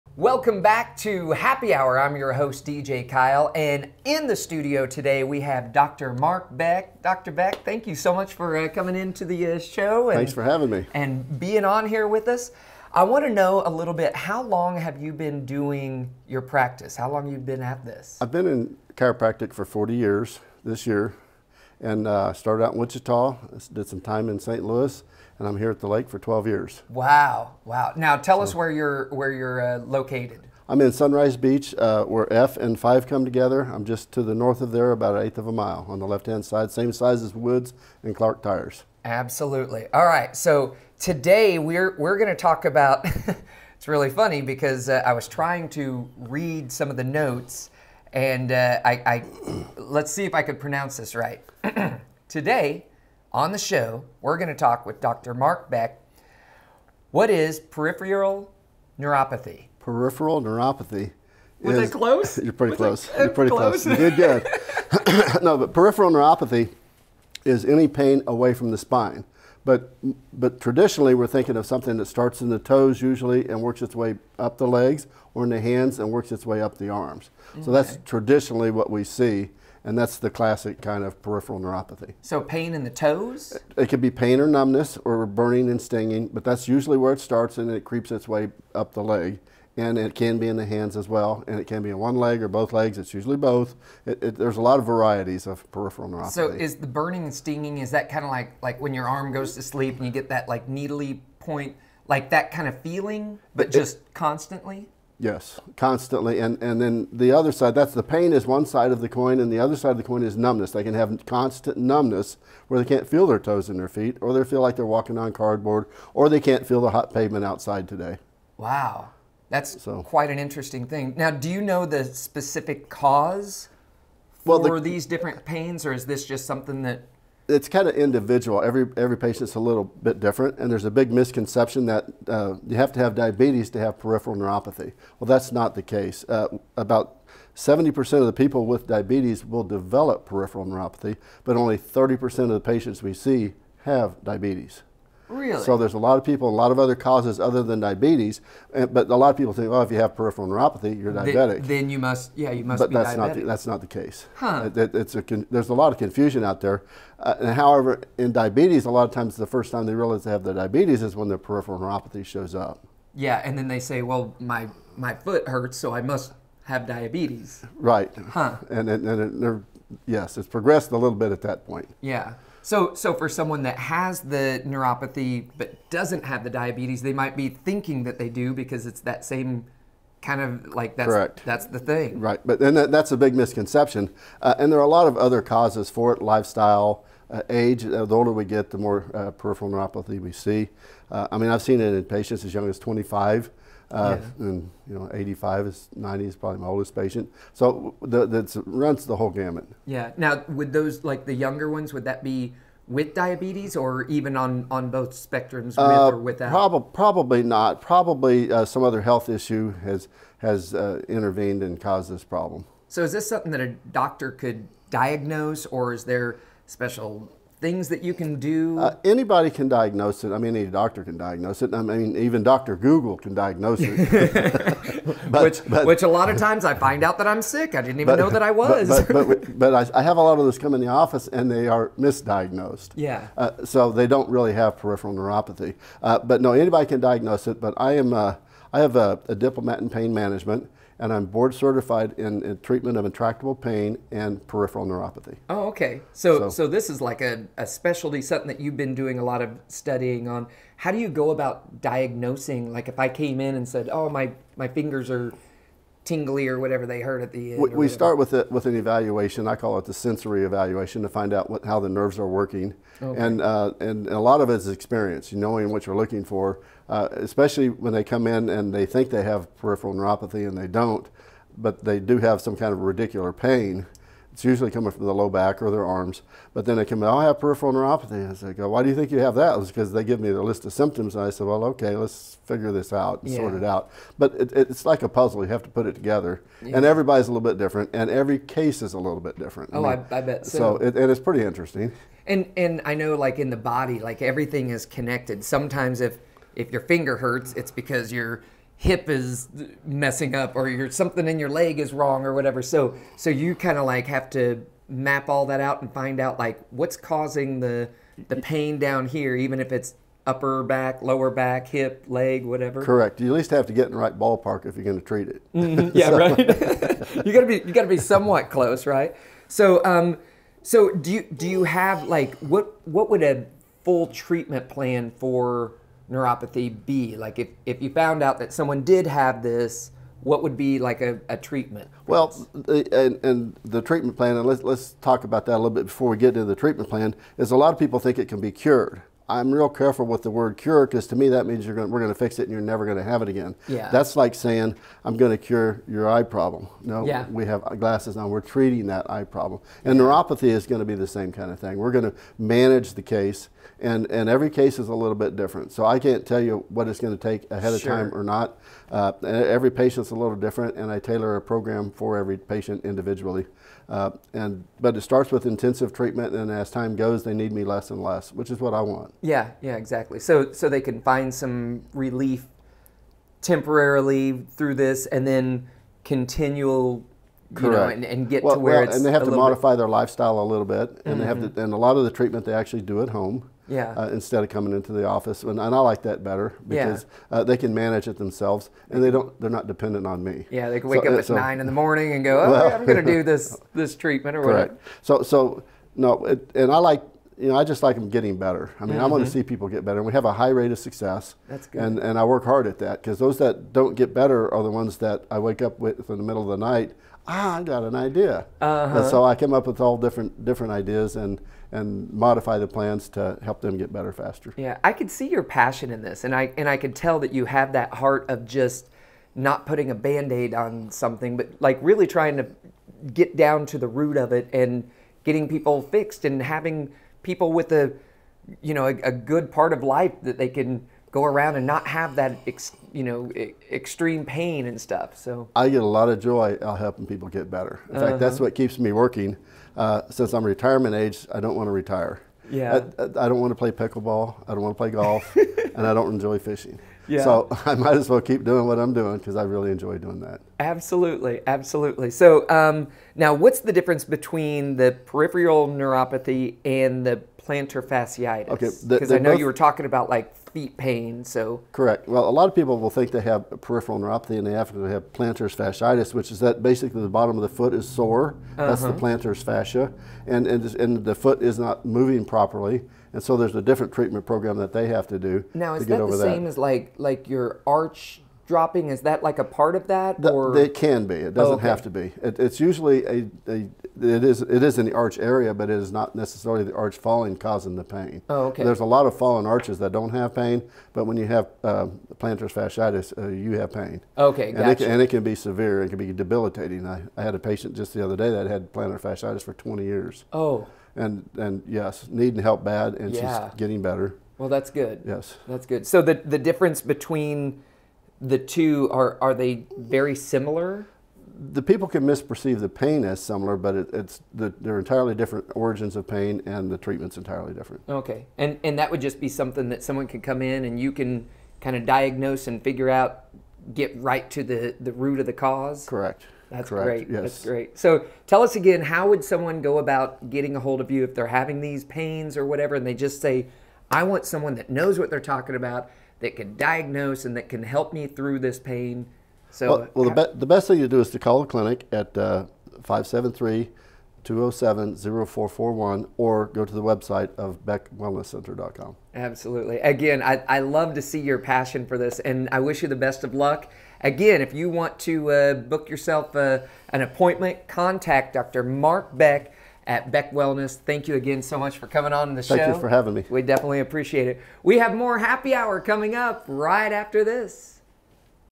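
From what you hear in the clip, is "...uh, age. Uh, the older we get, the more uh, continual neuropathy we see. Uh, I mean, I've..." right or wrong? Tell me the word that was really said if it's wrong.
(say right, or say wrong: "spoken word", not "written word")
wrong: "peripheral", not "continual".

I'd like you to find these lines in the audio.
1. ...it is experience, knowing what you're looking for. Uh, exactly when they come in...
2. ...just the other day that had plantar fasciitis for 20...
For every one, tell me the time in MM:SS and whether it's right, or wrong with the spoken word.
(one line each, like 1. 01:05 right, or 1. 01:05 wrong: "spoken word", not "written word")
1. 04:24 wrong: "especially", not "exactly"
2. 08:17 right.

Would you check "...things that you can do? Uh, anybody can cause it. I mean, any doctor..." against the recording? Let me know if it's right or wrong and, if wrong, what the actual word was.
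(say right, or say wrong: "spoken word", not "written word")
wrong: "diagnose", not "cause".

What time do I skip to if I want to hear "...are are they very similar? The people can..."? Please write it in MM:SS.
08:28.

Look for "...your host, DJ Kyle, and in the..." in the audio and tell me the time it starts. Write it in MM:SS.
00:02.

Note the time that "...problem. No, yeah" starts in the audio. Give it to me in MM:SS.
05:46.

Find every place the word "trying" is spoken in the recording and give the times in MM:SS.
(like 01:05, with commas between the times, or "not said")
00:45, 07:02.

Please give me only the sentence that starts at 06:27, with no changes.
uh, they can manage it themselves and they don't, they're not dependent on me.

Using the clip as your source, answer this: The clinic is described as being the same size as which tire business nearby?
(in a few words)
Woods and Clark Tires.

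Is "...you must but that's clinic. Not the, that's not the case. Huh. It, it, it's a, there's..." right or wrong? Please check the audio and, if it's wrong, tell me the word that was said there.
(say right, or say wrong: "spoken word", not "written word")
wrong: "diabetic", not "clinic".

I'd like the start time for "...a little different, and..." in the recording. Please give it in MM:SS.
06:00.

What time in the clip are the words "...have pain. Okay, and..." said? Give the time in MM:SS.
08:13.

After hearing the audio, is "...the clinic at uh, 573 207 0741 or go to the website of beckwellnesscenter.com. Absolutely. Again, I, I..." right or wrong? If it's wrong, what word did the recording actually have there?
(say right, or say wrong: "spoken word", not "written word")
wrong: "0441", not "0741".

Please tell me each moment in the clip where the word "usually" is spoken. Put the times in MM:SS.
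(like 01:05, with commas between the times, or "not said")
01:13, 01:26, 01:33, 04:34, 08:02.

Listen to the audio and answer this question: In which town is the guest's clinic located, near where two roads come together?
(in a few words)
Sunrise Beach.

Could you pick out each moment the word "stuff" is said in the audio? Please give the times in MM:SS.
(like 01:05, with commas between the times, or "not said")
07:14.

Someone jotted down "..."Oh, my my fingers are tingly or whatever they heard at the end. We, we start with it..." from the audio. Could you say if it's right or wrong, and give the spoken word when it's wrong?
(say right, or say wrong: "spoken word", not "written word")
right.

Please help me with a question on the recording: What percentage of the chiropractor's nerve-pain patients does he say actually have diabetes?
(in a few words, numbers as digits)
30%.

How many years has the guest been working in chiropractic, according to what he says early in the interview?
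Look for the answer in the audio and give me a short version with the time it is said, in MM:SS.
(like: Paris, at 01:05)
40, at 00:19.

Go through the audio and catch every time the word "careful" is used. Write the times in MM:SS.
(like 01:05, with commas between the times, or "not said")
05:39.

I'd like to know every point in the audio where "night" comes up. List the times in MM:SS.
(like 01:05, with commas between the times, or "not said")
06:46.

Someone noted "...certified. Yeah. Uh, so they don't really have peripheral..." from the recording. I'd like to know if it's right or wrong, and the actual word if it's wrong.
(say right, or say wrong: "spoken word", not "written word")
wrong: "misdiagnosed", not "certified".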